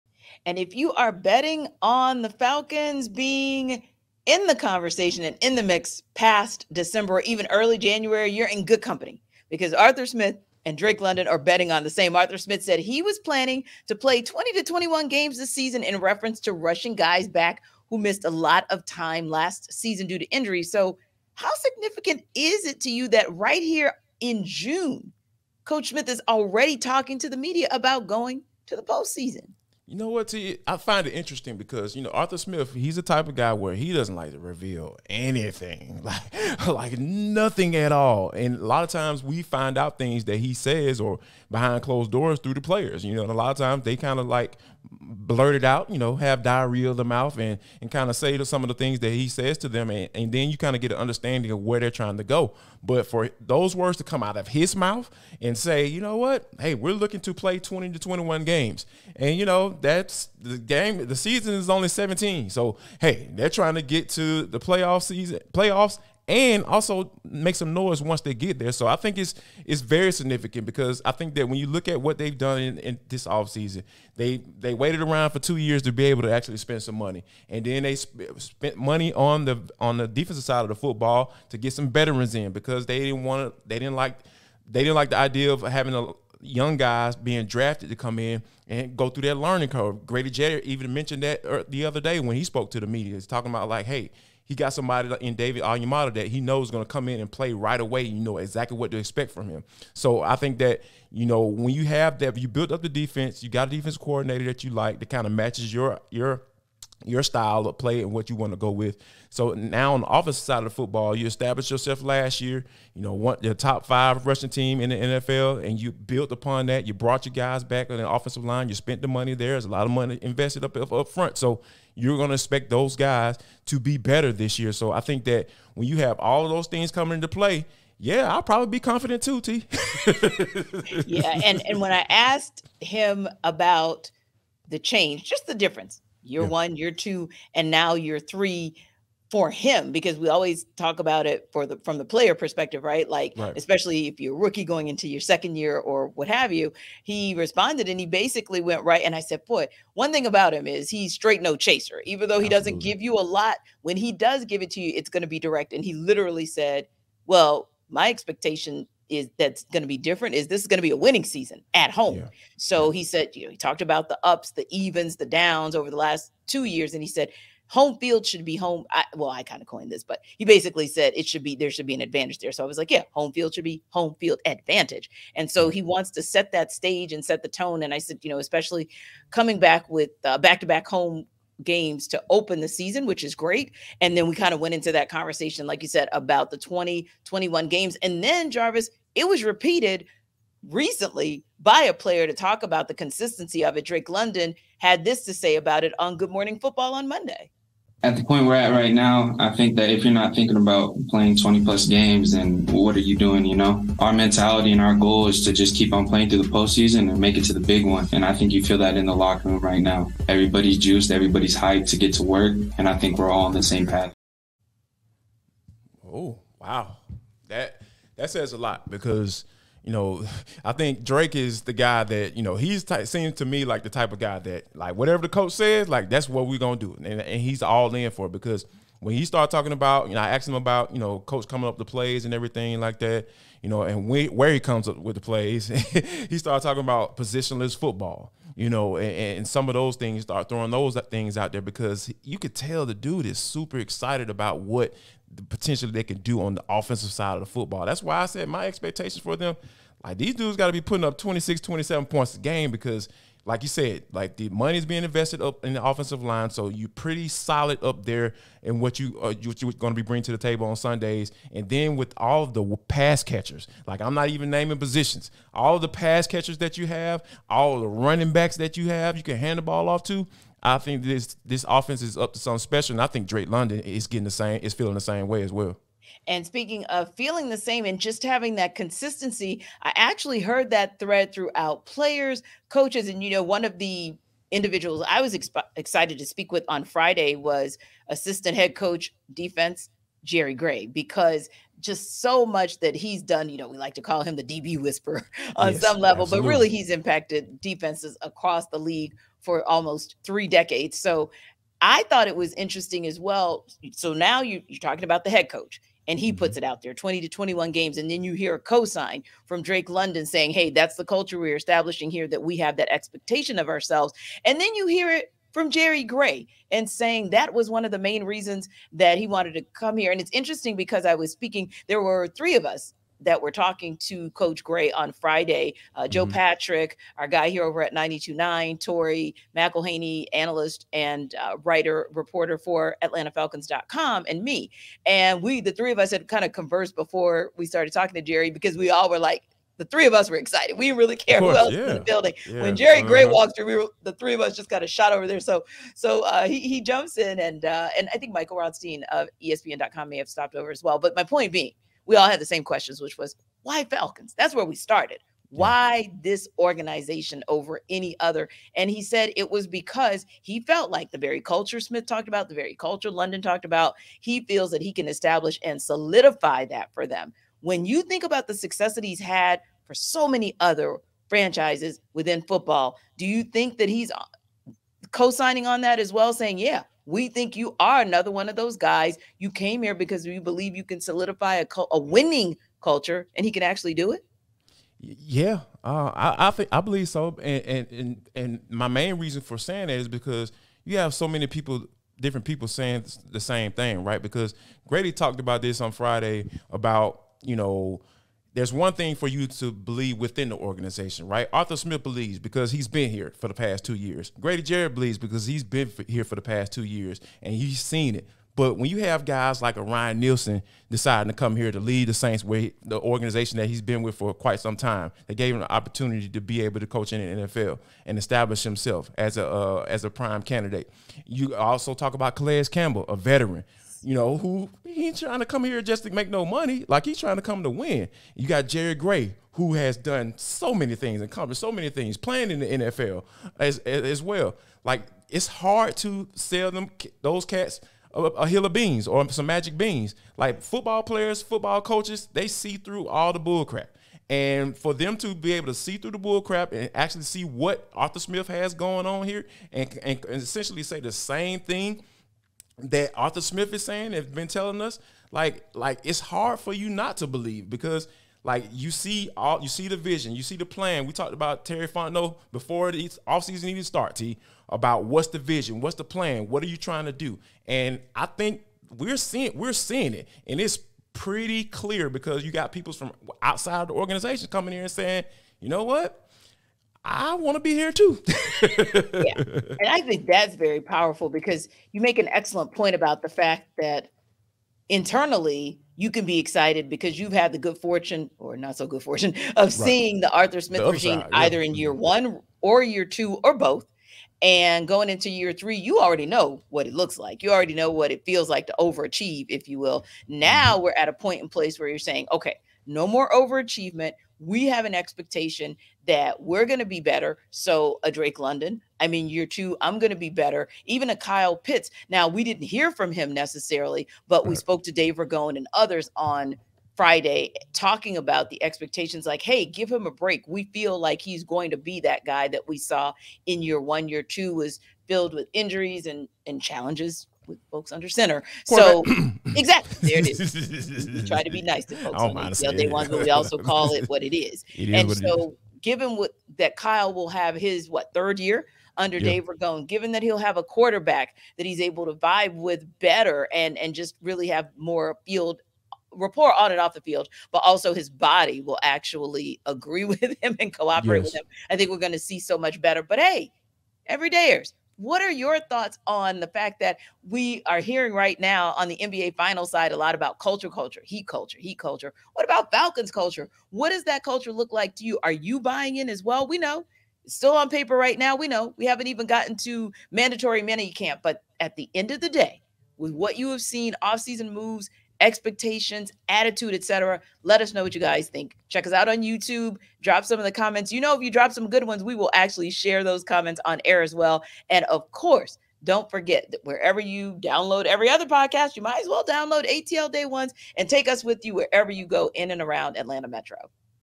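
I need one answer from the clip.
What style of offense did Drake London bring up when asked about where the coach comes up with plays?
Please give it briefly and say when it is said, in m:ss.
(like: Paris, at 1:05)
Positionless football, at 3:57.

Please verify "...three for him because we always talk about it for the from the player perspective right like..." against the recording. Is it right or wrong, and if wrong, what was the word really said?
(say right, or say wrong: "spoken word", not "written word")
right.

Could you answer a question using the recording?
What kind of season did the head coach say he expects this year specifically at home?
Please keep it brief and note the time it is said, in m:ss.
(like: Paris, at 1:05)
A winning season, at 2:40.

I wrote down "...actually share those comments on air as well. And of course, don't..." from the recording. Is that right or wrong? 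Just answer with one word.
right.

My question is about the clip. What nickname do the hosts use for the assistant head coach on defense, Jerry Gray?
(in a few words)
The DB whisperer.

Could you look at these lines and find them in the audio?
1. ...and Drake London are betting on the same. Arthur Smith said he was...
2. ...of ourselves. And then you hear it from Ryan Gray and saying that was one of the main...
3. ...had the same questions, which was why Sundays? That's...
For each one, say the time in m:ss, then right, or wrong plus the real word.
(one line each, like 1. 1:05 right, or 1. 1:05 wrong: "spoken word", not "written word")
1. 0:10 right
2. 5:13 wrong: "Jerry", not "Ryan"
3. 5:52 wrong: "Falcons", not "Sundays".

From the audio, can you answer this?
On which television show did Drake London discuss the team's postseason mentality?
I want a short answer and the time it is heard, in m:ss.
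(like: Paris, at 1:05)
Good Morning Football, at 3:16.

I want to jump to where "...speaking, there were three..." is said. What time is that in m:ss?
5:21.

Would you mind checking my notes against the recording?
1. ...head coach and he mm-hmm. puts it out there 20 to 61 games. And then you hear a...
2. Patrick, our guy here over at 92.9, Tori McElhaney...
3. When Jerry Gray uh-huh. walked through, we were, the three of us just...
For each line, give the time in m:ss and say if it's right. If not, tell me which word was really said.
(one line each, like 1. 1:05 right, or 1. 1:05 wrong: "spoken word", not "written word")
1. 5:05 wrong: "21", not "61"
2. 5:26 right
3. 5:42 right.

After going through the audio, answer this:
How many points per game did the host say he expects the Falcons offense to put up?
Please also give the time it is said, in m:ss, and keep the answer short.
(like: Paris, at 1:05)
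26, 27, at 4:11.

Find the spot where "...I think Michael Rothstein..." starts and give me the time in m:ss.
5:48.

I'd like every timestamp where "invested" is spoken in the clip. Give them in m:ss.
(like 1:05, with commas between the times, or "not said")
2:00, 4:15.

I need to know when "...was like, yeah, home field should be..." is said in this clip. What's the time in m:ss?
2:52.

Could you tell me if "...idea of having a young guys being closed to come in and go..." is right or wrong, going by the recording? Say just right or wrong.
wrong.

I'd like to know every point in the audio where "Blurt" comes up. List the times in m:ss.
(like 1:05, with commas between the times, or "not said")
0:44.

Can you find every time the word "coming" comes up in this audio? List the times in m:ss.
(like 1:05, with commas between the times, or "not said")
2:06, 2:59, 3:51, 7:54.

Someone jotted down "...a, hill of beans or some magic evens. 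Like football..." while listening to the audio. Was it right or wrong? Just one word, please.
wrong.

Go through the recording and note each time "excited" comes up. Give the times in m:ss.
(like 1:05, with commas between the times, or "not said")
4:03, 4:45, 5:40, 8:06.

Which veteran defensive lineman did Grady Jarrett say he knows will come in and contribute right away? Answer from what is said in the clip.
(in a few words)
David Onyemata.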